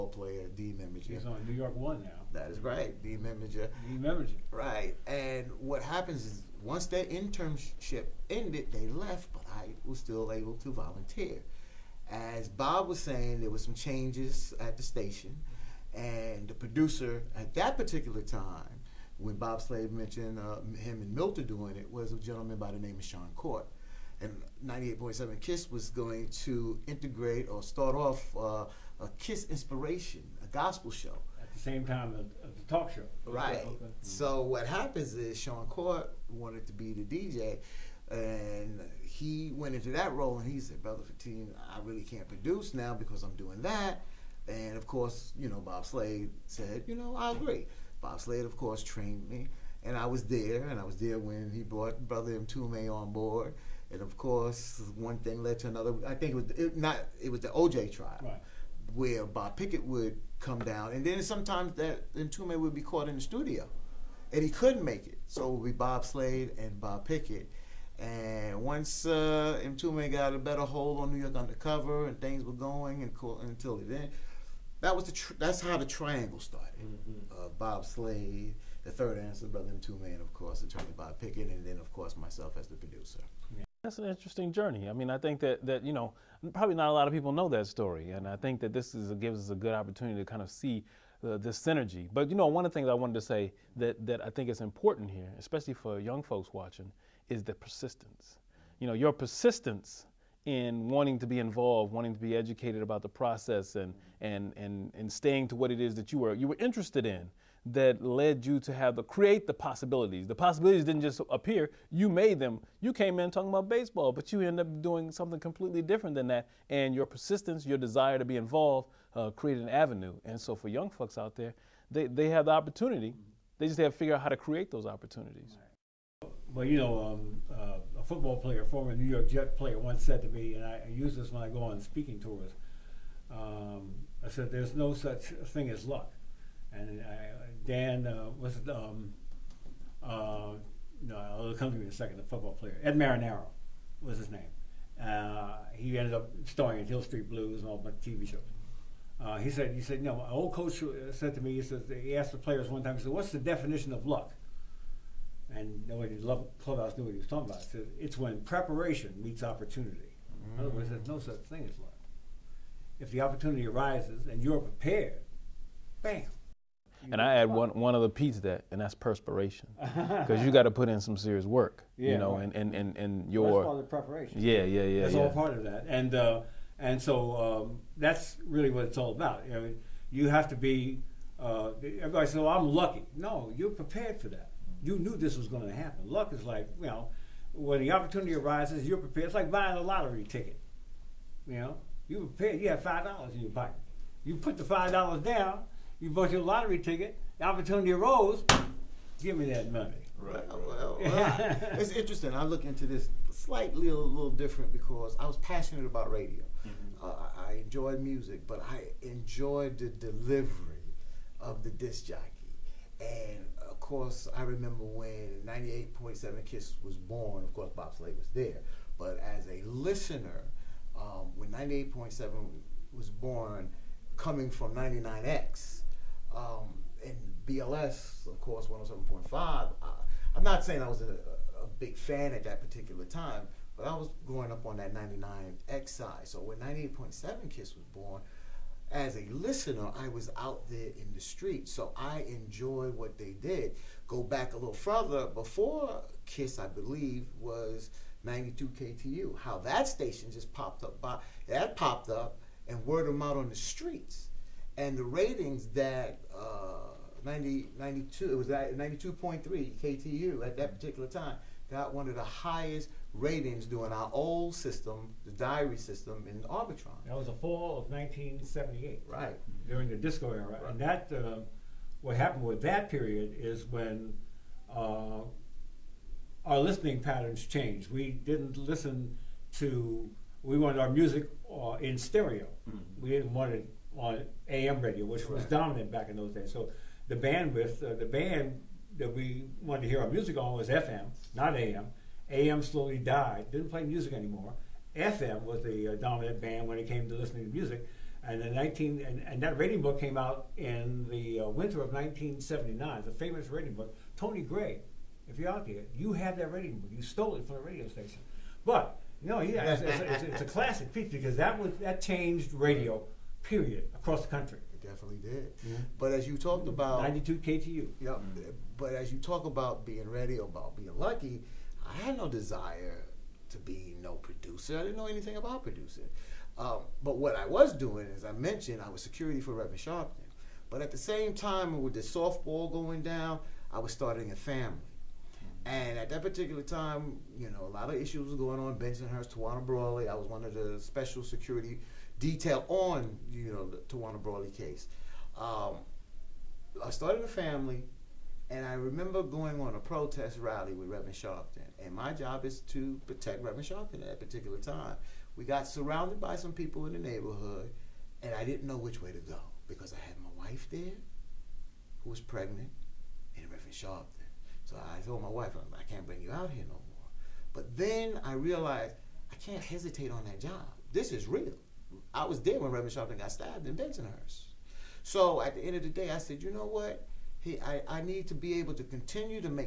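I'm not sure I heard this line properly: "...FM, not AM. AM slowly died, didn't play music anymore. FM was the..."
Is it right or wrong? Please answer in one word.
right.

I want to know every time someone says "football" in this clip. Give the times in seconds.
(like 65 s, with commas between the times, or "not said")
128 s, 142 s.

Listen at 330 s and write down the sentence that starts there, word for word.
But at the same time, with the softball going down, I was starting a family.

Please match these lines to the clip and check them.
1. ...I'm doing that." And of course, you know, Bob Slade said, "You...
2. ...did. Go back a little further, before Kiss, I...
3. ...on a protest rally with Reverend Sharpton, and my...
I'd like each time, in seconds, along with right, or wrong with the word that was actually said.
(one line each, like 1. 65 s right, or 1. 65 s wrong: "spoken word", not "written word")
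1. 43 s right
2. 243 s right
3. 349 s right.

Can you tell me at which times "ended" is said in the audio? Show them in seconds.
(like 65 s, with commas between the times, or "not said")
8 s, 145 s.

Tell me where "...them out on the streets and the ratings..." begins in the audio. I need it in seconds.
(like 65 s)
253 s.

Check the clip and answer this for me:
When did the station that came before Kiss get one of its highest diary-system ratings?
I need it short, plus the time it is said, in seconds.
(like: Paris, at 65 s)
fall of 1978, at 267 s.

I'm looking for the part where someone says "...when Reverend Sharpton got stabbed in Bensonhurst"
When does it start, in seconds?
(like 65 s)
372 s.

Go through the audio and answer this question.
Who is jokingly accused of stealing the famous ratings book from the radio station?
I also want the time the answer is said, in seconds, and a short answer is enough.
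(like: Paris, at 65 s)
Tony Gray, at 304 s.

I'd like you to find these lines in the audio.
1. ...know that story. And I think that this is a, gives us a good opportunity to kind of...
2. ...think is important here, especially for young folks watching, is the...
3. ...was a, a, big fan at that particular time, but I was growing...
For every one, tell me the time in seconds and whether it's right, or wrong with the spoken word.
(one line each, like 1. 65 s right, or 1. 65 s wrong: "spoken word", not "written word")
1. 87 s right
2. 94 s right
3. 230 s right.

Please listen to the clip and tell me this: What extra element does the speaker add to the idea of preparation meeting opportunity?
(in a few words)
perspiration.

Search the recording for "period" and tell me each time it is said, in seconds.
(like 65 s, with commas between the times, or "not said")
272 s, 313 s.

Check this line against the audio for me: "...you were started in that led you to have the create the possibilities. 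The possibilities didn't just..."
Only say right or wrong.
wrong.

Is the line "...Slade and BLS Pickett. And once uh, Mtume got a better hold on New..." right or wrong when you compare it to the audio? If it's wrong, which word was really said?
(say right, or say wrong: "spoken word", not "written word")
wrong: "Bob", not "BLS".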